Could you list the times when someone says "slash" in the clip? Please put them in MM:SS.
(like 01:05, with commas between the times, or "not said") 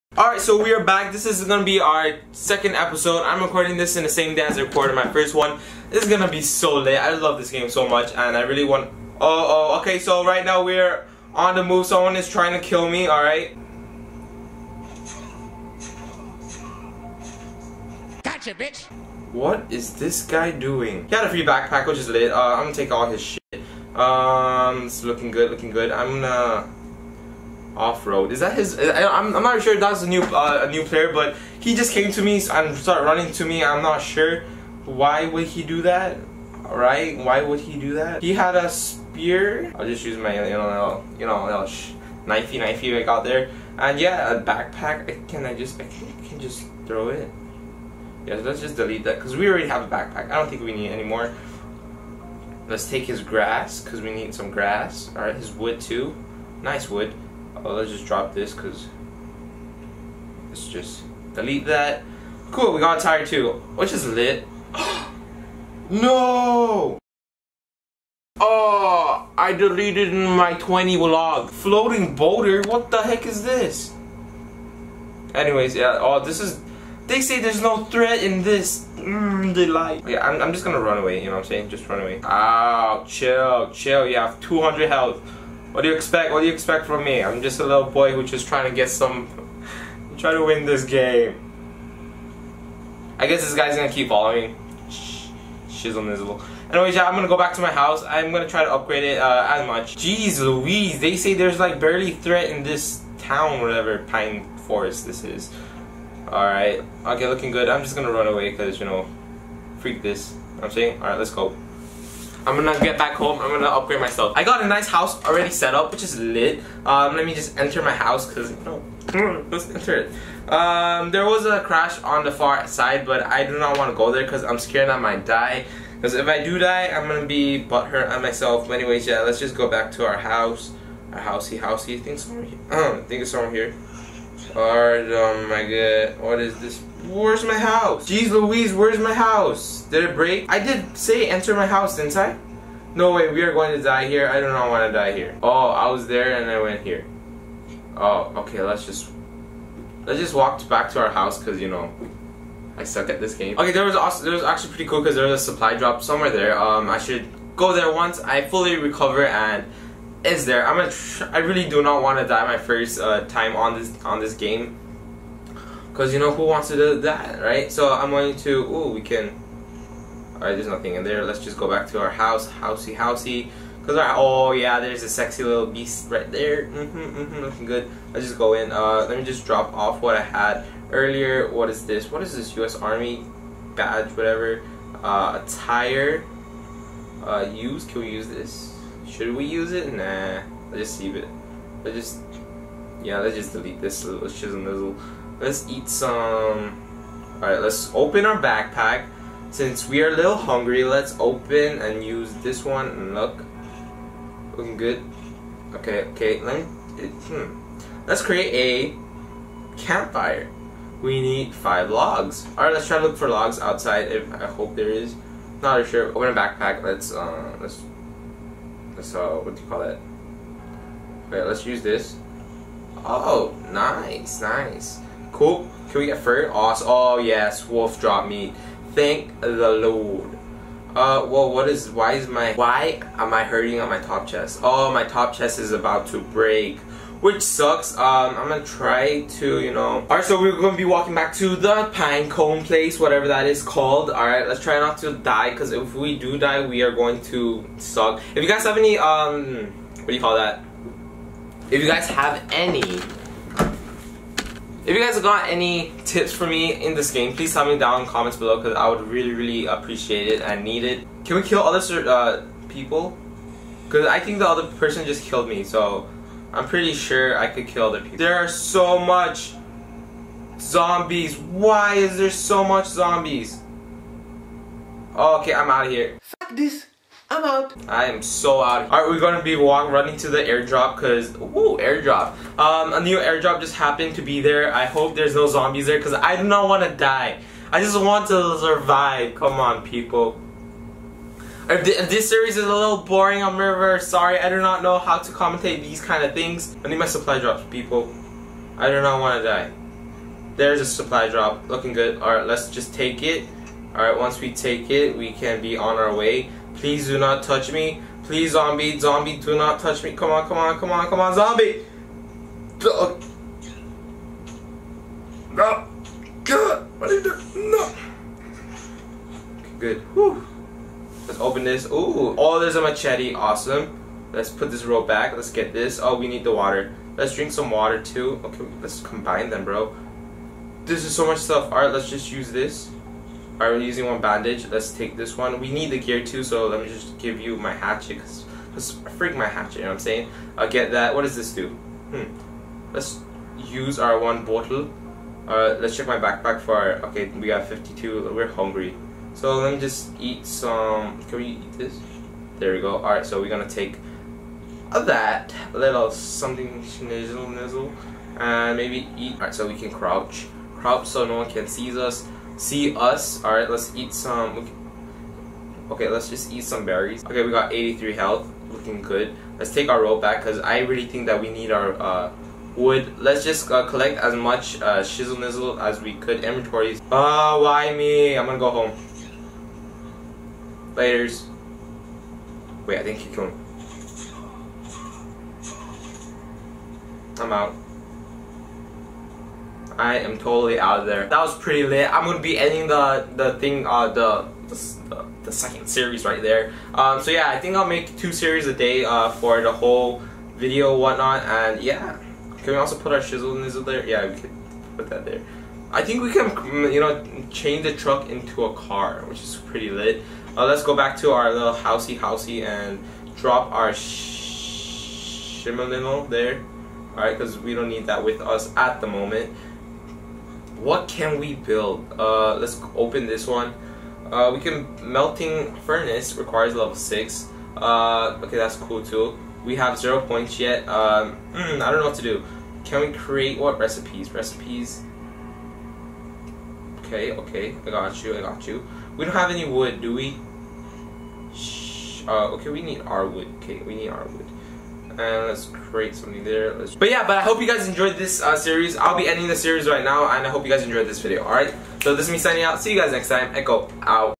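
not said.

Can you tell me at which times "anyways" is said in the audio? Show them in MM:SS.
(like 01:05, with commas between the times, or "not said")
01:15, 01:36, 02:08.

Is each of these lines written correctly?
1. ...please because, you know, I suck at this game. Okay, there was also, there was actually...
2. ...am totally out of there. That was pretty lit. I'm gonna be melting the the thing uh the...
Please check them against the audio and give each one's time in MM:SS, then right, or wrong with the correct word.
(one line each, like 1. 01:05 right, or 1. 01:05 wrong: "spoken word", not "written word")
1. 02:31 wrong: "house", not "please"
2. 06:30 wrong: "ending", not "melting".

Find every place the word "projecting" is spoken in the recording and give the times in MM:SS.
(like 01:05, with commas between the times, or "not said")
not said.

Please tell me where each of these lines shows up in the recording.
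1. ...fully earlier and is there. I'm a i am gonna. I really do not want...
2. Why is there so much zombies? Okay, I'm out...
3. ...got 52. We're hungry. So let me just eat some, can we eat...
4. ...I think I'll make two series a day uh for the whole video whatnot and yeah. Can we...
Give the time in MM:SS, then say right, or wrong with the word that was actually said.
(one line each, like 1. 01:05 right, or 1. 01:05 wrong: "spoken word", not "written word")
1. 02:38 wrong: "recover", not "earlier"
2. 04:31 right
3. 05:47 right
4. 06:37 right.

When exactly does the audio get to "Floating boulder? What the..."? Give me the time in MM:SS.
01:11.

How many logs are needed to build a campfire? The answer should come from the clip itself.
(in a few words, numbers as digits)
5.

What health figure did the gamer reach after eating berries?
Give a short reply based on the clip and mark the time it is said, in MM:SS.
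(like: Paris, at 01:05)
83, at 06:07.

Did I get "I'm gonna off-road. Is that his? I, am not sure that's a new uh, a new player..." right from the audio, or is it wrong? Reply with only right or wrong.
right.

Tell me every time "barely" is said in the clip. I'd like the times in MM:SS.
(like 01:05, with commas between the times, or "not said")
01:41.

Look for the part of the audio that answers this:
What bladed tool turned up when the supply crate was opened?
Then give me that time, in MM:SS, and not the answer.
05:22.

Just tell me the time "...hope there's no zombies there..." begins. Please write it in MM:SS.
04:44.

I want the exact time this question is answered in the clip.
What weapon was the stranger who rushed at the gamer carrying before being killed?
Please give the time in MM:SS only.
00:38.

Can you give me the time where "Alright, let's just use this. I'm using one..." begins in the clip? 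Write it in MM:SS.
05:31.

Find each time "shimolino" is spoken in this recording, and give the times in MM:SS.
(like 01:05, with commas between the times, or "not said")
06:53.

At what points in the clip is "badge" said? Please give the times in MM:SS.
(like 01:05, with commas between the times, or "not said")
03:03.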